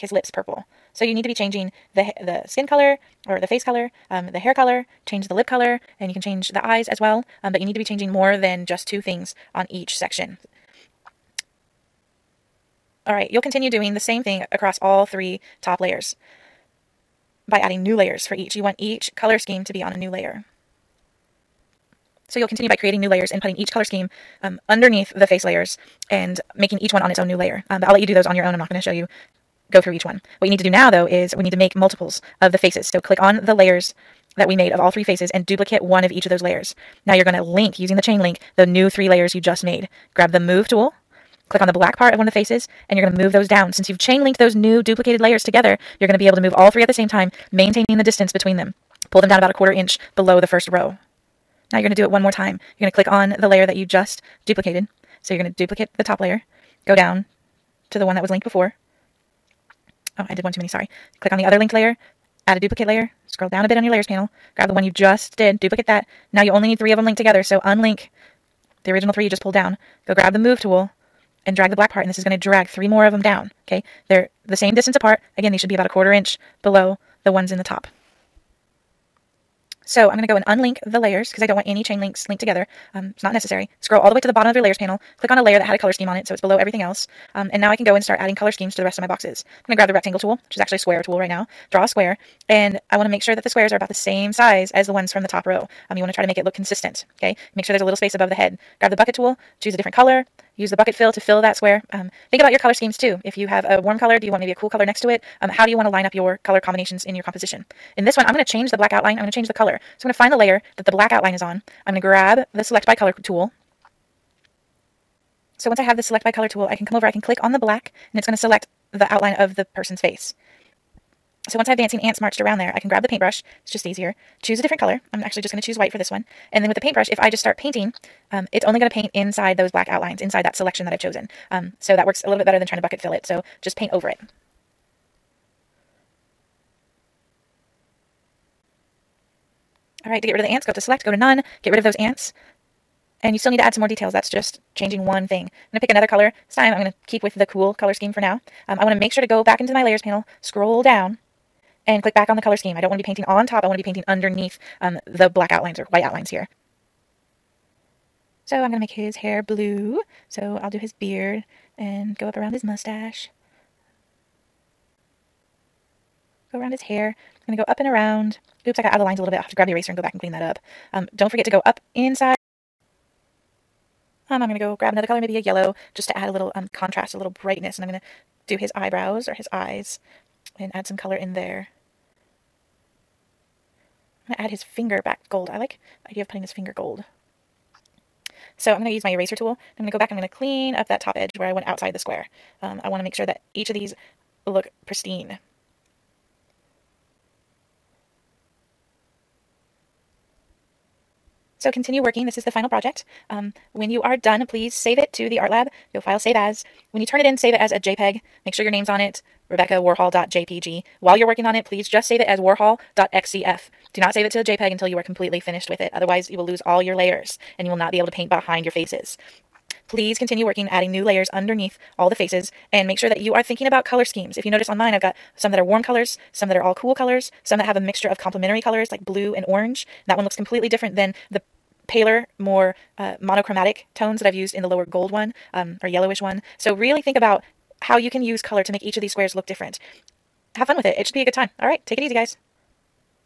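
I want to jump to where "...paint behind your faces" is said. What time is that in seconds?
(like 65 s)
218 s.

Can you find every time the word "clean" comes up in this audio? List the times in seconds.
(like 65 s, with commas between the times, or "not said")
170 s, 190 s.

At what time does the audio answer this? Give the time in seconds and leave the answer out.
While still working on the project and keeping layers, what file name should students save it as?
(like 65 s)
212 s.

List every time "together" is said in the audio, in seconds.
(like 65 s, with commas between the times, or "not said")
45 s, 67 s, 82 s.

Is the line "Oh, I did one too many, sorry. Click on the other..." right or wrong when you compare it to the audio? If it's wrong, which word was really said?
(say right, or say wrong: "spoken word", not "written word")
right.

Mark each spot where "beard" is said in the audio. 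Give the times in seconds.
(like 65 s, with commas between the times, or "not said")
160 s.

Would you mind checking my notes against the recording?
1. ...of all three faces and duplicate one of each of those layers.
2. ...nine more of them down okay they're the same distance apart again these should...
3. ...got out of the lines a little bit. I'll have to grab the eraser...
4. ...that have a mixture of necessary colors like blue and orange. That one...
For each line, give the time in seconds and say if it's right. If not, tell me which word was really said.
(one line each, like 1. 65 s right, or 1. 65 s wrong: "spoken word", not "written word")
1. 34 s right
2. 72 s wrong: "three", not "nine"
3. 168 s right
4. 227 s wrong: "complementary", not "necessary".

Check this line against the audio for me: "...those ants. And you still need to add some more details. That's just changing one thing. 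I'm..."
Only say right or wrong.
right.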